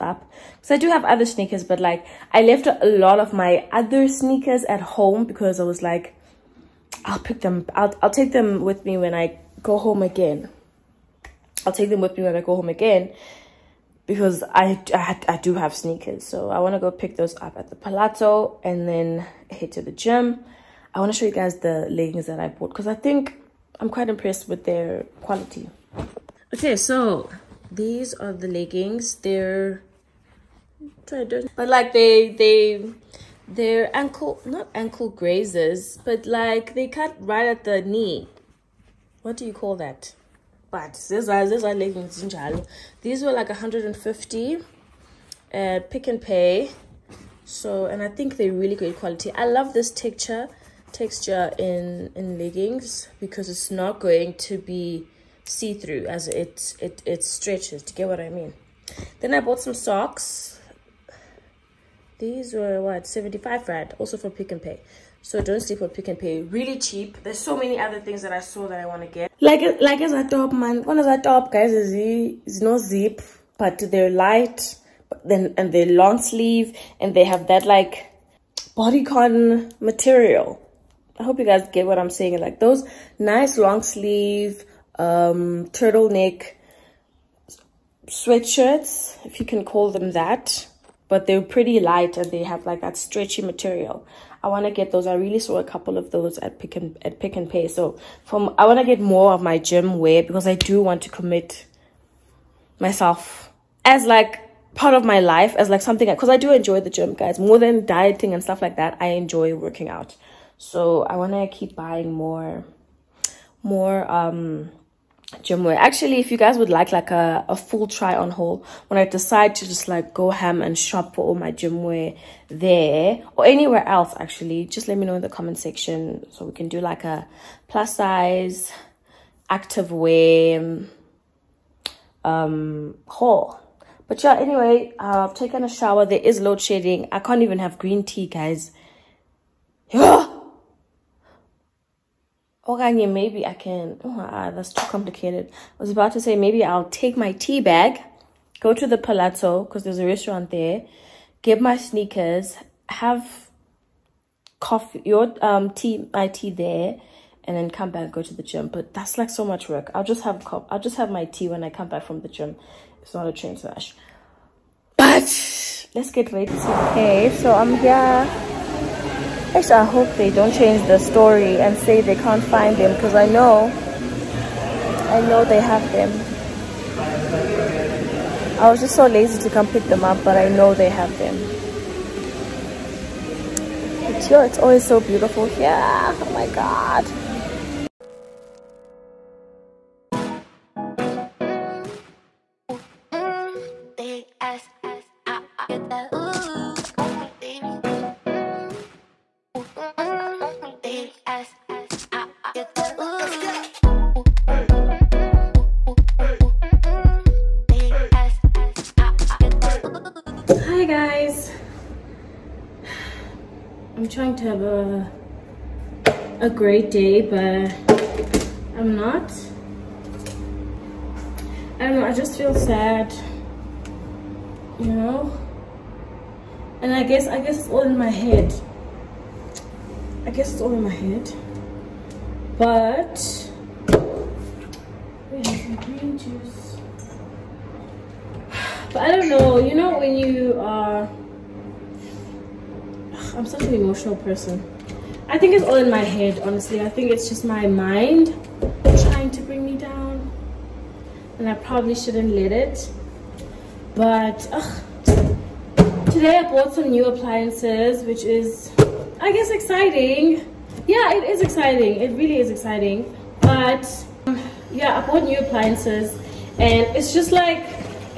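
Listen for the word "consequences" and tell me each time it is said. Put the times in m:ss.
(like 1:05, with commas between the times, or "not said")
not said.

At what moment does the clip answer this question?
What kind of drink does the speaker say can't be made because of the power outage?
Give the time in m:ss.
2:17.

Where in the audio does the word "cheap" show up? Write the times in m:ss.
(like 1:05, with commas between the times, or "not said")
1:06.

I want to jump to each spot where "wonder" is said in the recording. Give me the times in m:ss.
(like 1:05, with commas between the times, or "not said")
not said.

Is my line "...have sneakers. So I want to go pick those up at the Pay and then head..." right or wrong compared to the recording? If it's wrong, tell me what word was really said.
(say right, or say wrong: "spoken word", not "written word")
wrong: "Palazzo", not "Pay".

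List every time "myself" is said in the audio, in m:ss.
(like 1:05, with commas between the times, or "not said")
1:42.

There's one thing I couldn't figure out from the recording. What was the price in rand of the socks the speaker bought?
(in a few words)
75 rand.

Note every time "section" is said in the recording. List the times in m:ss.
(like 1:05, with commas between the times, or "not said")
2:05.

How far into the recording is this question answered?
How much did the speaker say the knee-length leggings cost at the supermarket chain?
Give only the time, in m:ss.
0:43.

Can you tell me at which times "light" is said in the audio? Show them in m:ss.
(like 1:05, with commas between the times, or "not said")
1:14, 1:31.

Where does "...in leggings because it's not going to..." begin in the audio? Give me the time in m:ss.
0:52.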